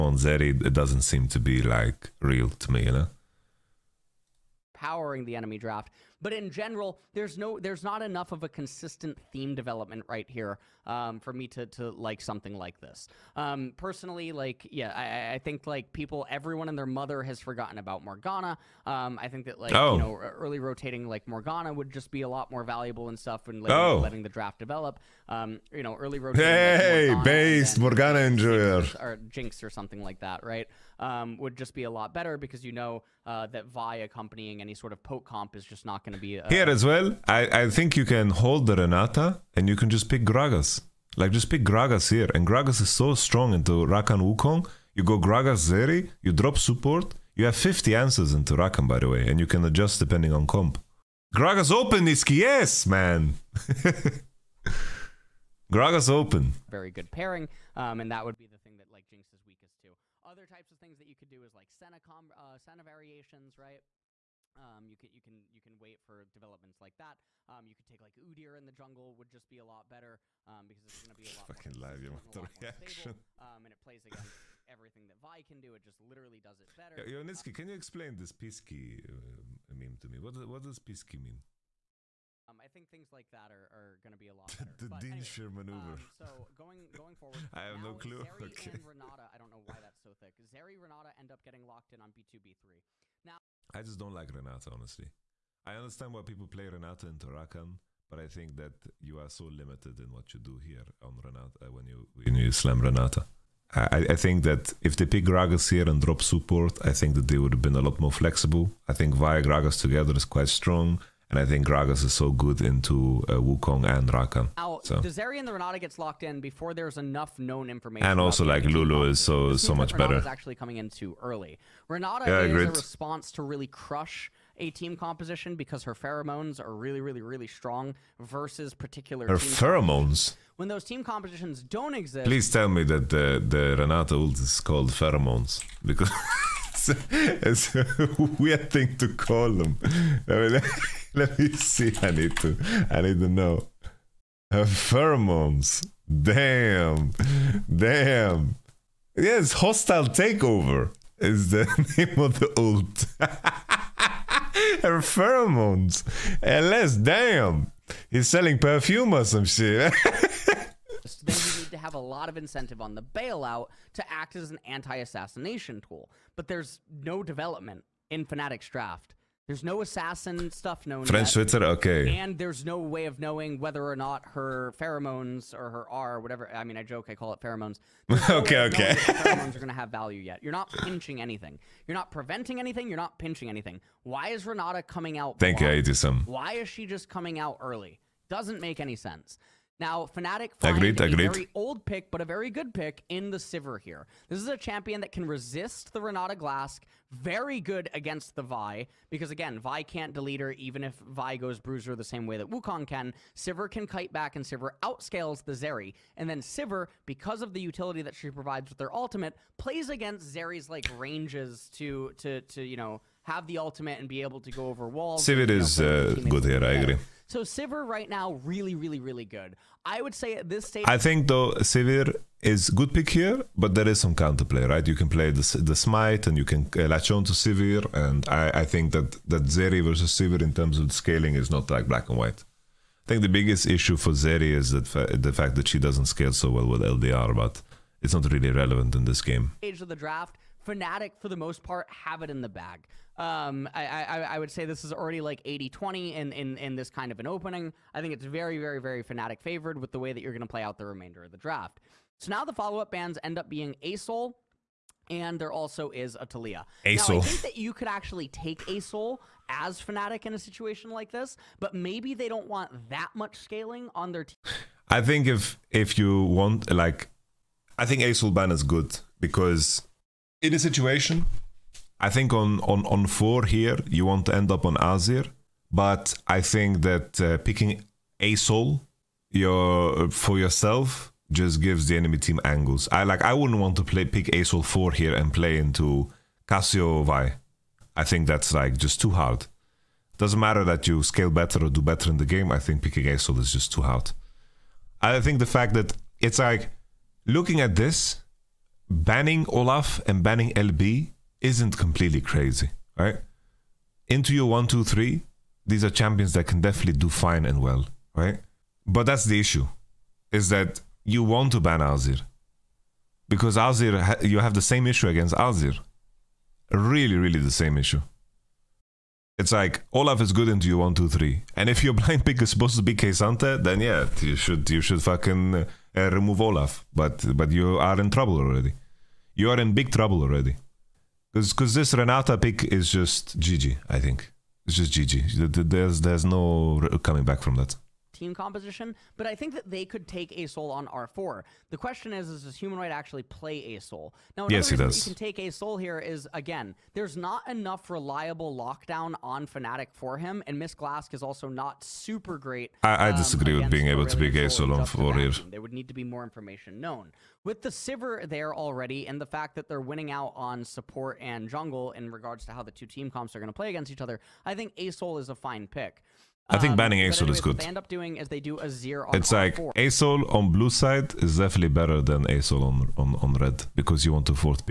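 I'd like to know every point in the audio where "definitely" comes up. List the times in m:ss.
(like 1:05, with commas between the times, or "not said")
5:06, 6:11.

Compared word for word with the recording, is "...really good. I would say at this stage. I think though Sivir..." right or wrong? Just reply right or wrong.
right.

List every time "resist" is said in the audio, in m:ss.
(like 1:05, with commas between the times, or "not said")
3:15.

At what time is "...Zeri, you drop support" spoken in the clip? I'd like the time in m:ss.
0:45.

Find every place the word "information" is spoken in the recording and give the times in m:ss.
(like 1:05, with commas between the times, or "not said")
1:57, 5:56.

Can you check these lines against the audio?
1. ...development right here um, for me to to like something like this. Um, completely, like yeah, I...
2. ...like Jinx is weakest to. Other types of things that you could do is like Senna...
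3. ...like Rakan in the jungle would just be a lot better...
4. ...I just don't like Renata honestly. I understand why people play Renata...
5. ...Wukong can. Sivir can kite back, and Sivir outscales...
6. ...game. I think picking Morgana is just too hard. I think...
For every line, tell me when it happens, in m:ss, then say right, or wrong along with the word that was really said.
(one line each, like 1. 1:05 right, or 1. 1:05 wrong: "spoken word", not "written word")
1. 0:09 wrong: "personally", not "completely"
2. 0:58 right
3. 1:07 wrong: "Udyr", not "Rakan"
4. 1:33 right
5. 3:22 right
6. 4:52 wrong: "ASol", not "Morgana".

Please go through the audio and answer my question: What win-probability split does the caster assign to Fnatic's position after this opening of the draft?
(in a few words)
80 20.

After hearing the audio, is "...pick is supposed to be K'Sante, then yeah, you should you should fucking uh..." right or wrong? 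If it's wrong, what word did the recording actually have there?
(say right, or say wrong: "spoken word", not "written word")
right.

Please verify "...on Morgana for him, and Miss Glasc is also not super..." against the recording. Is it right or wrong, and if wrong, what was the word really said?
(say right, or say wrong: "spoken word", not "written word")
wrong: "Fnatic", not "Morgana".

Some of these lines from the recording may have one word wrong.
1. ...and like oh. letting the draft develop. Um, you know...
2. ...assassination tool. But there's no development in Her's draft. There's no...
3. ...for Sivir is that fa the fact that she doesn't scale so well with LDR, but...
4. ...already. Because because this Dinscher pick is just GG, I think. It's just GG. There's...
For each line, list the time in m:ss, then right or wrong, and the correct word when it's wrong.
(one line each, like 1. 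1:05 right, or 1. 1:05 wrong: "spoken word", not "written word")
1. 0:23 right
2. 2:44 wrong: "Fnatic", not "Her"
3. 3:53 wrong: "Zeri", not "Sivir"
4. 5:30 wrong: "Renata", not "Dinscher".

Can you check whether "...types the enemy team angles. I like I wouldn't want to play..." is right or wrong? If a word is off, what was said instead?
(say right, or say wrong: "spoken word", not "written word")
wrong: "gives", not "types".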